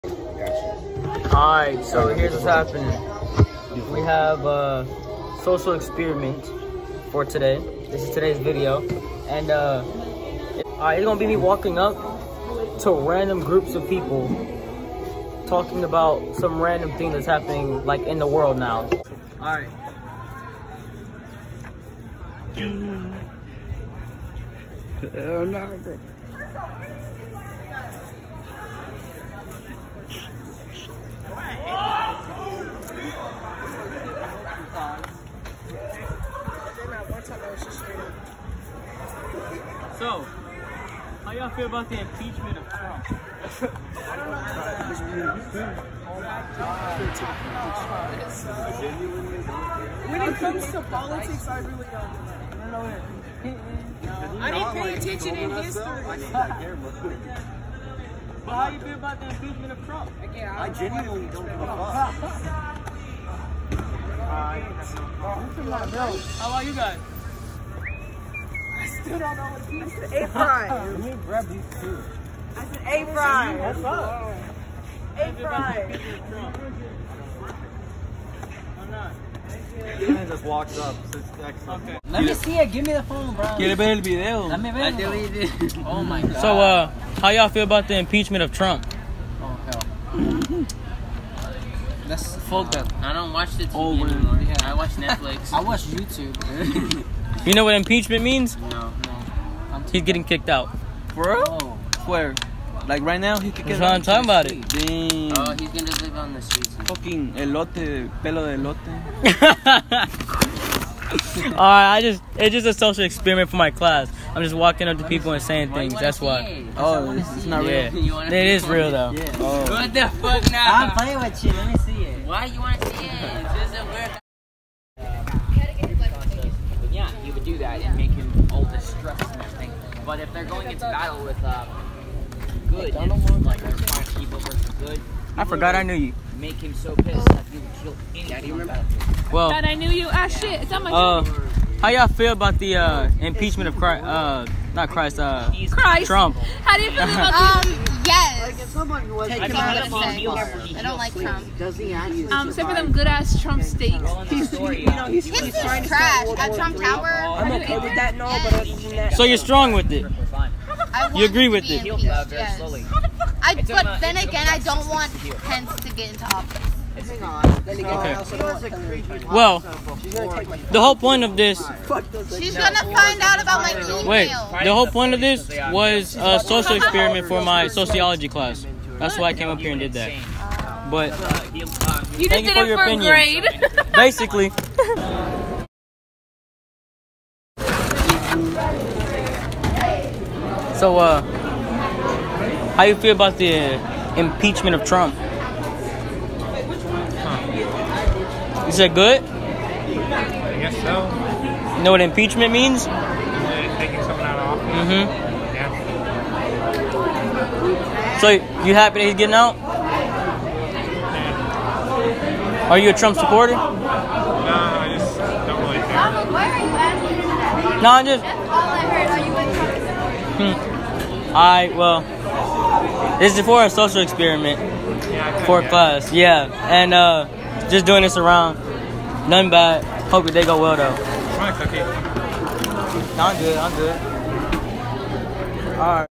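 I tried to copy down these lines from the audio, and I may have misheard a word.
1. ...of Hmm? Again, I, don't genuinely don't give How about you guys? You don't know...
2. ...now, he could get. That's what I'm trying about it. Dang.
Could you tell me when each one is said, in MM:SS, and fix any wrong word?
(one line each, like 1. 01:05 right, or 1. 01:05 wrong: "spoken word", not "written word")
1. 00:59 wrong: "Trump", not "Hmm"
2. 01:43 wrong: "talking", not "trying".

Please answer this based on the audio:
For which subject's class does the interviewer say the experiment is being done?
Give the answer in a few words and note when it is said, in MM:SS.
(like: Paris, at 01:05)
Sociology, at 02:57.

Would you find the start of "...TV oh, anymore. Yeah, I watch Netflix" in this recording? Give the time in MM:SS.
01:33.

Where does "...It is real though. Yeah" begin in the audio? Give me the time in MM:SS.
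01:58.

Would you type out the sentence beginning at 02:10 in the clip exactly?
But if they're going into battle with uh, good, and, like they're trying to keep over for good.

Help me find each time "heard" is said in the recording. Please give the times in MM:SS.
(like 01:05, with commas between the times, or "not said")
03:38.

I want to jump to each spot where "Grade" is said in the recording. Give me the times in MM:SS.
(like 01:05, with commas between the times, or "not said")
03:03.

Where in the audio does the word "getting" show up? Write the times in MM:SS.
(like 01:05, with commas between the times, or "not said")
01:40, 03:29.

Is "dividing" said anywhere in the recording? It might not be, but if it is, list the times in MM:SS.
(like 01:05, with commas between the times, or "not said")
not said.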